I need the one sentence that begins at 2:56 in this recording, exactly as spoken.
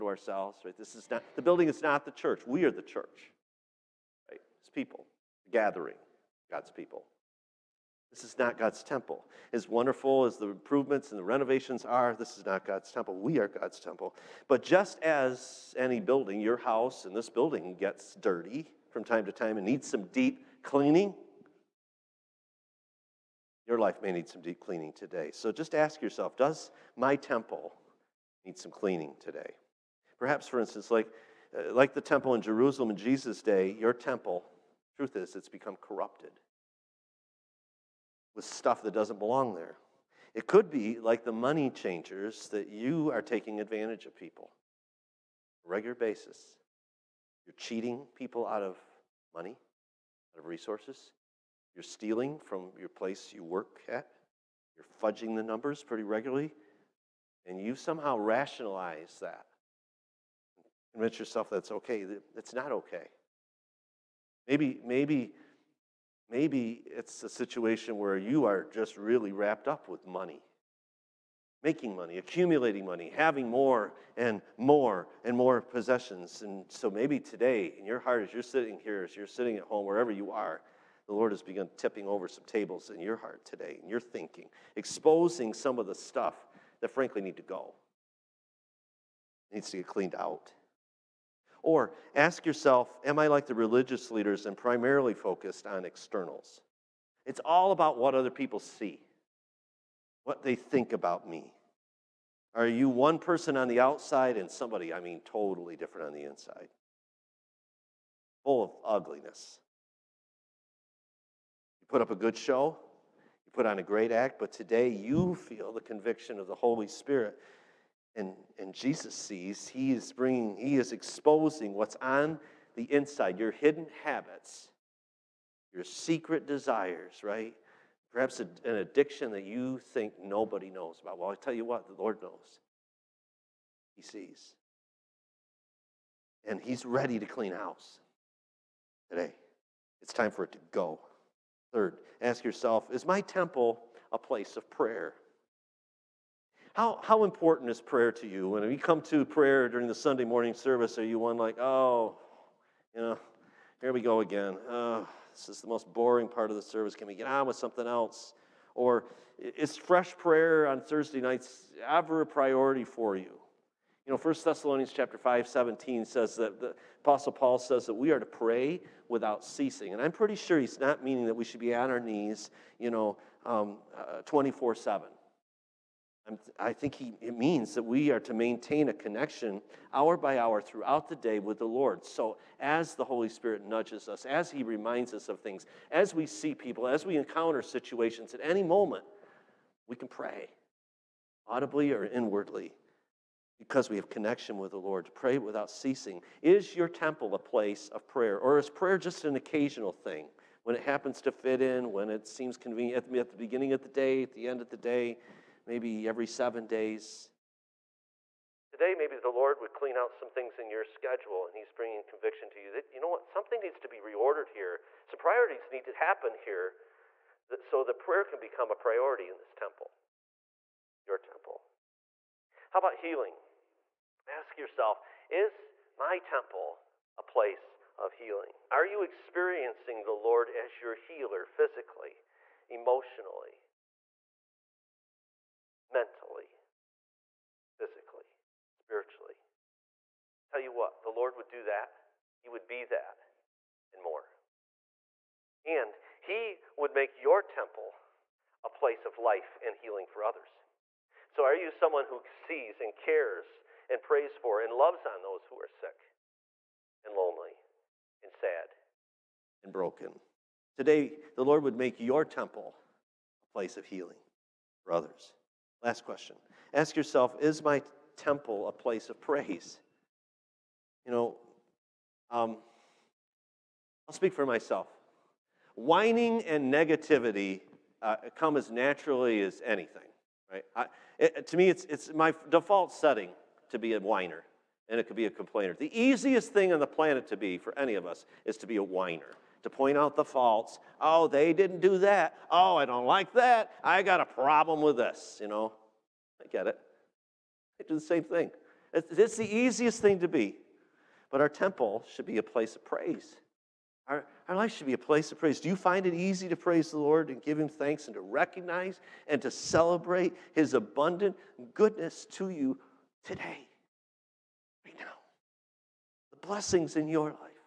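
Uh, I think he, it means that we are to maintain a connection hour by hour throughout the day with the Lord.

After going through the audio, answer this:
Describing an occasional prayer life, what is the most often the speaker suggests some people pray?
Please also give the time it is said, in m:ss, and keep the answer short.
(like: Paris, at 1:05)
every seven days, at 3:26.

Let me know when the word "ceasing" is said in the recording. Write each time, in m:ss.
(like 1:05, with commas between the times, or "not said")
2:49, 3:15.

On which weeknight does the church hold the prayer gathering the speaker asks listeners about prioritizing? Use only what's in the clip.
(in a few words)
Thursday.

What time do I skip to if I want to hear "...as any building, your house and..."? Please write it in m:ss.
0:15.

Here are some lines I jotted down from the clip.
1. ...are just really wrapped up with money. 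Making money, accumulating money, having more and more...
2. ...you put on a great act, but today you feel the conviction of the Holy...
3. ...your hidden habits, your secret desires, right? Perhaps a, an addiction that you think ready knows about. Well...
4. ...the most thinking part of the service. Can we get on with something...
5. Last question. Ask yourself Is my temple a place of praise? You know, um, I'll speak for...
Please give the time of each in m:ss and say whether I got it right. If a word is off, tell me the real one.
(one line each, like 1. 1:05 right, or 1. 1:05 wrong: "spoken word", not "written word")
1. 1:08 right
2. 1:53 right
3. 2:03 wrong: "nobody", not "ready"
4. 2:35 wrong: "boring", not "thinking"
5. 4:25 right.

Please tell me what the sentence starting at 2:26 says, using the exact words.
How, how important is prayer to you?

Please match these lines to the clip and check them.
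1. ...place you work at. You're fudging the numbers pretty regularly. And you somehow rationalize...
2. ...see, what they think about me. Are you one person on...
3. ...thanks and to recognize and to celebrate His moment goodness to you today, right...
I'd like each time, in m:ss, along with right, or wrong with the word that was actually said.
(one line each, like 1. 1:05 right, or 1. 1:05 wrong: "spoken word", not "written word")
1. 0:52 right
2. 1:38 right
3. 5:07 wrong: "abundant", not "moment".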